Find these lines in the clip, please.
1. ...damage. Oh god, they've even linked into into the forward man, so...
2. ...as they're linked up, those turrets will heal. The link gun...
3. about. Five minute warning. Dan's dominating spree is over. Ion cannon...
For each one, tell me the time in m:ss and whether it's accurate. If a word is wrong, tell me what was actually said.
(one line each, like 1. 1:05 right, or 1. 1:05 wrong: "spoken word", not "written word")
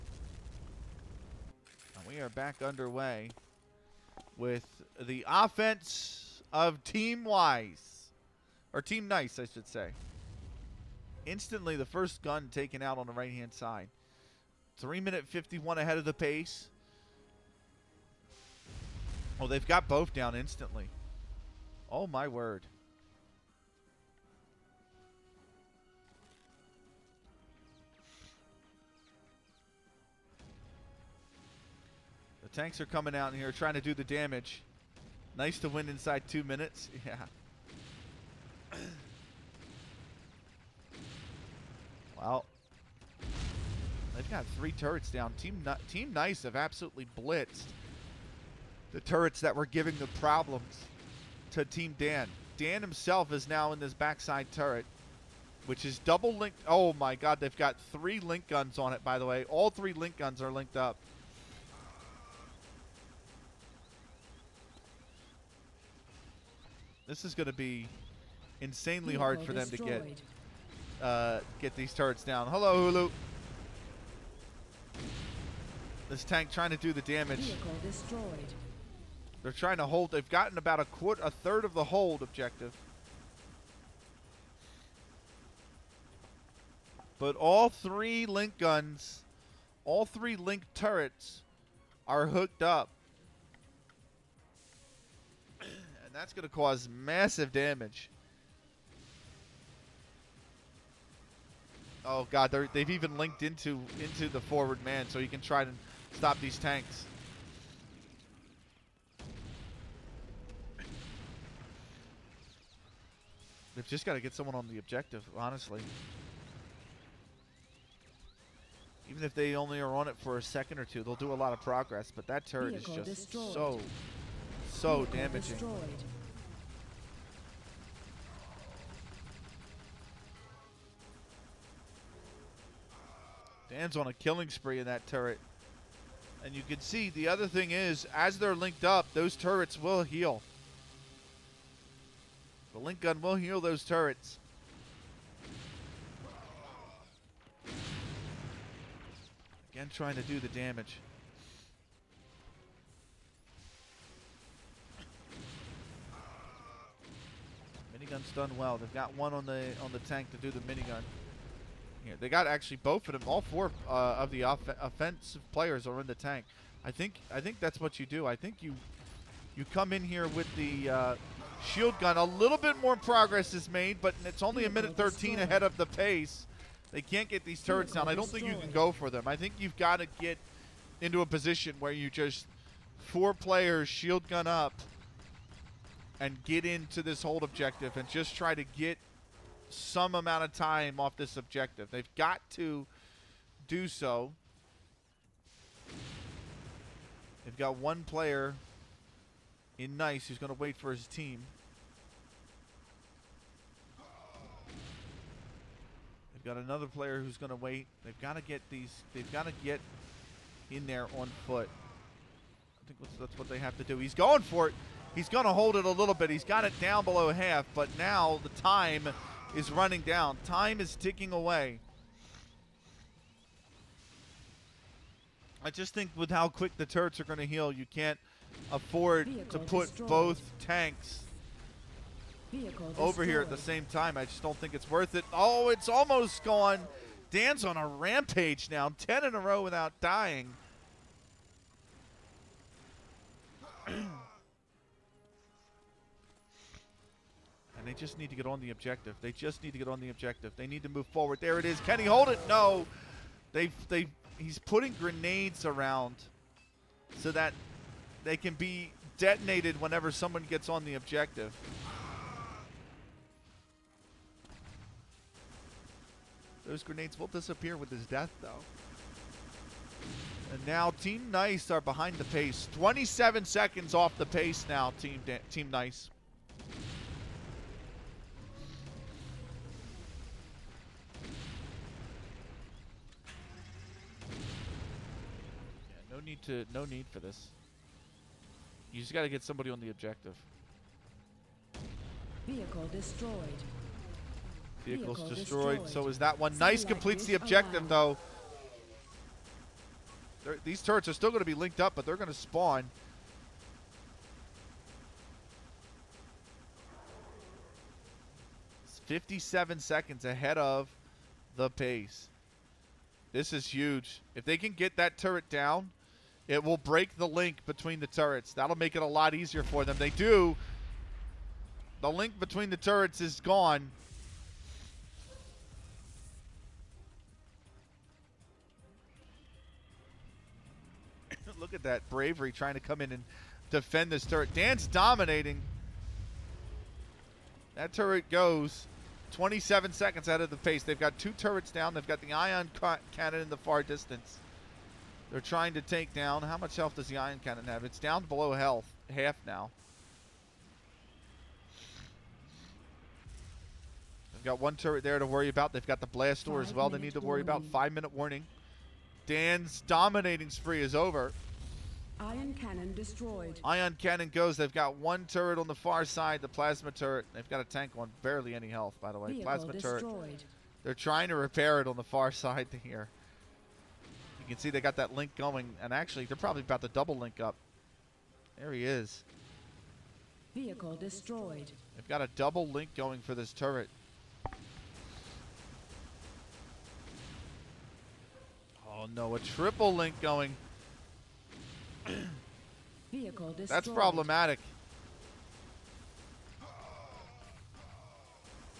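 1. 1:37 right
2. 2:18 right
3. 5:57 right.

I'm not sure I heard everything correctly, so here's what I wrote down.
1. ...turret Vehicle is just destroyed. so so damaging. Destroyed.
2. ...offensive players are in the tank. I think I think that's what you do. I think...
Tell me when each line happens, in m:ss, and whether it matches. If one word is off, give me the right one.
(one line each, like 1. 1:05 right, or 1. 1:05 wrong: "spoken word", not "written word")
1. 2:02 right
2. 2:44 right.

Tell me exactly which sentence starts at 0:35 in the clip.
Nice to win inside two minutes.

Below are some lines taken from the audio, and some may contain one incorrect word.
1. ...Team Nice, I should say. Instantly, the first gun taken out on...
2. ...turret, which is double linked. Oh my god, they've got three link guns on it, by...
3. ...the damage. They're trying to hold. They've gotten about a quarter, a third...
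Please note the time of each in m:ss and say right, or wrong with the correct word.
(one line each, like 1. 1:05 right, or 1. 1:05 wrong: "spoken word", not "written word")
1. 0:08 right
2. 0:54 right
3. 1:16 right.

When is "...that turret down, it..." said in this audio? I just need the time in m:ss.
5:14.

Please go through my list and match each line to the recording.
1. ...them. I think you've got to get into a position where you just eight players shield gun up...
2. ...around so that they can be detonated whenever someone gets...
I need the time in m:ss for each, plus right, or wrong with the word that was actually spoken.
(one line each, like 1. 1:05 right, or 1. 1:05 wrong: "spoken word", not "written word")
1. 2:59 wrong: "four", not "eight"
2. 4:15 right.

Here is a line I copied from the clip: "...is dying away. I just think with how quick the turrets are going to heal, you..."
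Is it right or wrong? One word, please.
wrong.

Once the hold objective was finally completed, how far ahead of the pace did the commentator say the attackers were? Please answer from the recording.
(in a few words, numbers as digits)
57 seconds.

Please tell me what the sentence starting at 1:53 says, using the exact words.
They've just got to get someone on the objective, honestly.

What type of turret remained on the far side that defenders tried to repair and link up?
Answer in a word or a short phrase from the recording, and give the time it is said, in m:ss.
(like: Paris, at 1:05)
Plasma turret, at 6:06.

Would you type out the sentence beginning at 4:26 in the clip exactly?
Those grenades will disappear with his death, though.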